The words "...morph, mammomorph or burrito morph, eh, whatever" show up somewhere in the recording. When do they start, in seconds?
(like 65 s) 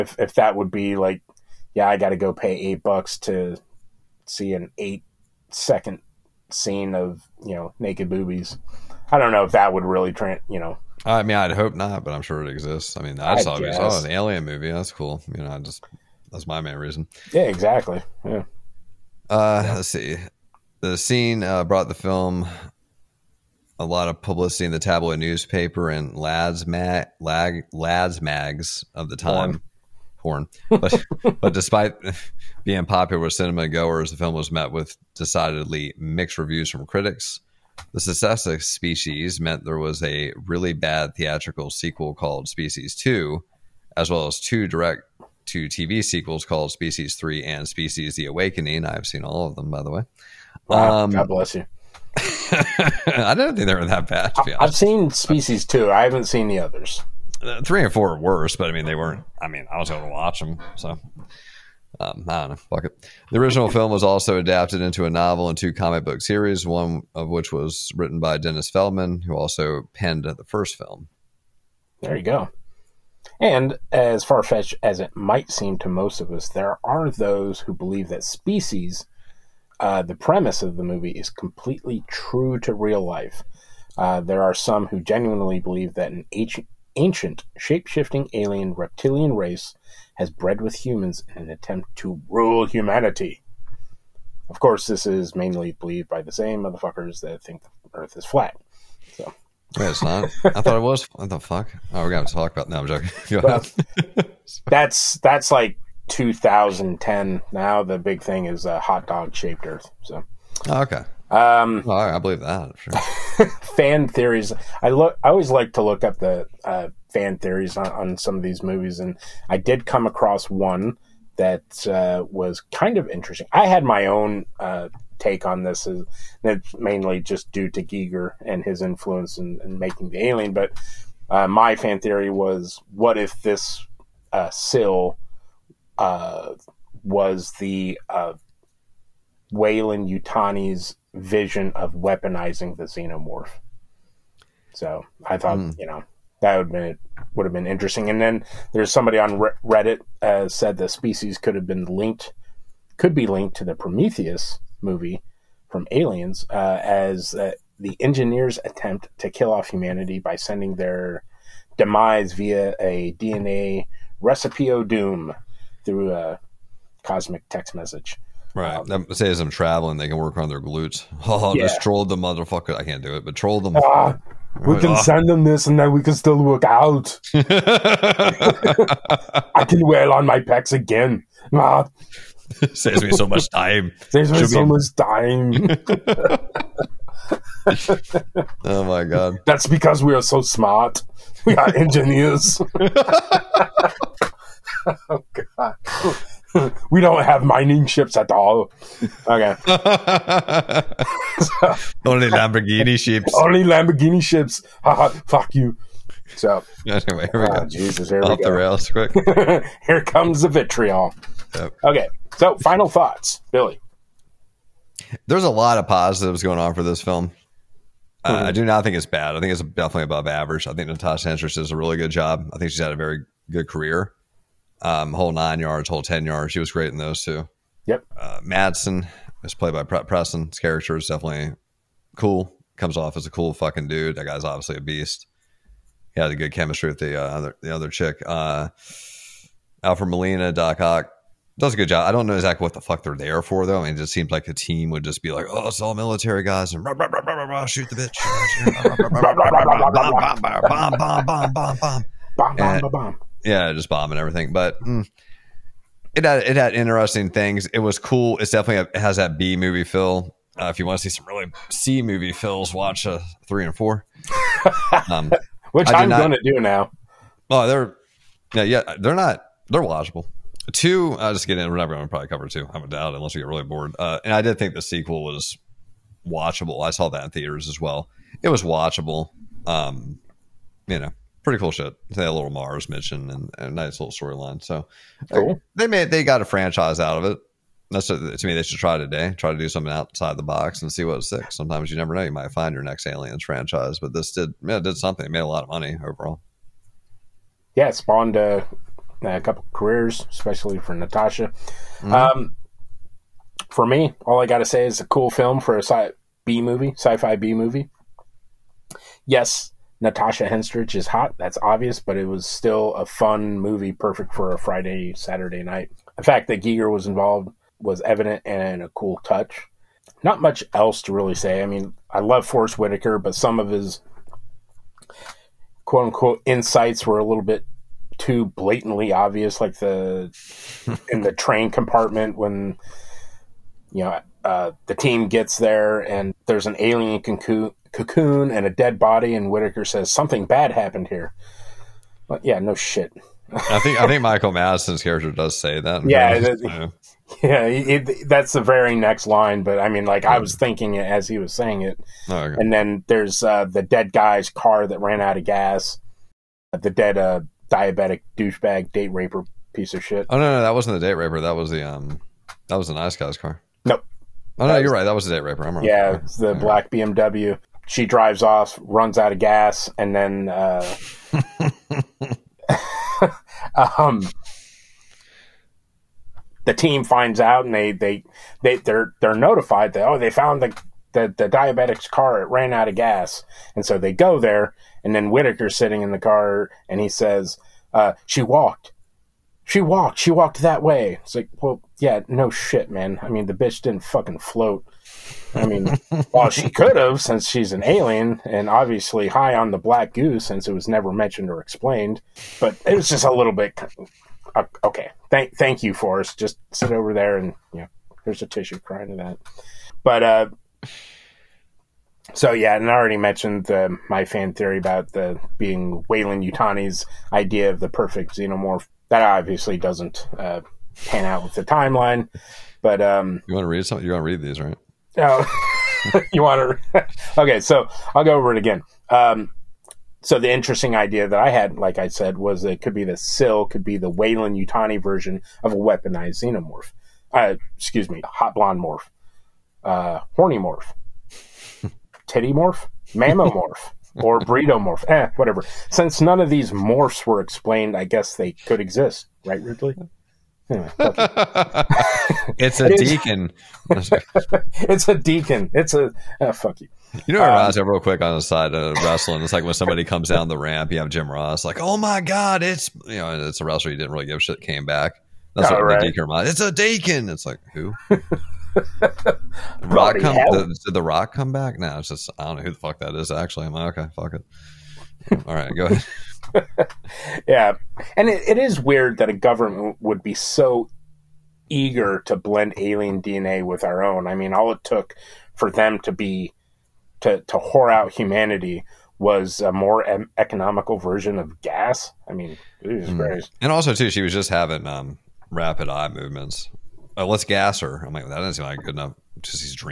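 442 s.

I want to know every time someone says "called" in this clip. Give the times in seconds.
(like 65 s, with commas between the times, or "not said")
42 s, 46 s.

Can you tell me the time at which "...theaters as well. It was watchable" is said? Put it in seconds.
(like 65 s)
277 s.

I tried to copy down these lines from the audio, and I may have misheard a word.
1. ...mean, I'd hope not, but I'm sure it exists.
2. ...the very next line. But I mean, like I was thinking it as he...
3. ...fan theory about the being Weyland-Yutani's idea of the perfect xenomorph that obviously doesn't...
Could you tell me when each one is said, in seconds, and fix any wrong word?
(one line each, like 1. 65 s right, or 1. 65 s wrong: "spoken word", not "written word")
1. 11 s right
2. 348 s right
3. 414 s right.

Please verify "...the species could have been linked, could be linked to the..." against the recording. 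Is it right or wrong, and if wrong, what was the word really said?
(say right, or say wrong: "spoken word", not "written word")
right.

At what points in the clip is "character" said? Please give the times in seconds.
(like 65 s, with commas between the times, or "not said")
230 s, 345 s.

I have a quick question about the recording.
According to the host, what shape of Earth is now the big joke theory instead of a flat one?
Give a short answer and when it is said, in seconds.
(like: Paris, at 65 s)
Hot dog shaped, at 108 s.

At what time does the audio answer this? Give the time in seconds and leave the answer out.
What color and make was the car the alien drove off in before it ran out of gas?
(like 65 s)
366 s.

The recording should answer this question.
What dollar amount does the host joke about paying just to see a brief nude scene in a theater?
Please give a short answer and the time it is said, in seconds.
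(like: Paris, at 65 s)
8 bucks, at 2 s.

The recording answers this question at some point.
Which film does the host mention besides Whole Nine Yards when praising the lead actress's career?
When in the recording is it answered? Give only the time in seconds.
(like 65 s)
225 s.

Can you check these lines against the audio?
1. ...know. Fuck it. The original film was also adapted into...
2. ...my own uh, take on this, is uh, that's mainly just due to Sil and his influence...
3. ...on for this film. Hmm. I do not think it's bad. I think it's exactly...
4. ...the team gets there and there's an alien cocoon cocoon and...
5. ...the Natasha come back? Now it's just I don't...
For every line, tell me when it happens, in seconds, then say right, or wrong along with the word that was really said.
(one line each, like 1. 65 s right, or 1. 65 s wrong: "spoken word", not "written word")
1. 62 s right
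2. 123 s wrong: "Giger", not "Sil"
3. 216 s wrong: "definitely", not "exactly"
4. 334 s right
5. 470 s wrong: "Rock", not "Natasha".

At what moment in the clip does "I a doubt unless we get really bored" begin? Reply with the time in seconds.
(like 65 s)
272 s.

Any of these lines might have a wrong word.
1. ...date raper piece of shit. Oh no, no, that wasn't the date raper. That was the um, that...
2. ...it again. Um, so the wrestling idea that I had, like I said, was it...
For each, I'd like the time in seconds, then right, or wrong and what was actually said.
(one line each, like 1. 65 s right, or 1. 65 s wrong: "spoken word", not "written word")
1. 358 s right
2. 428 s wrong: "interesting", not "wrestling".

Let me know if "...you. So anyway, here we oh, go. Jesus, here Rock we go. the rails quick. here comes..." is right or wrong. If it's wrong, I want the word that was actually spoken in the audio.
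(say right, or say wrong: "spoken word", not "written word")
wrong: "Off", not "Rock".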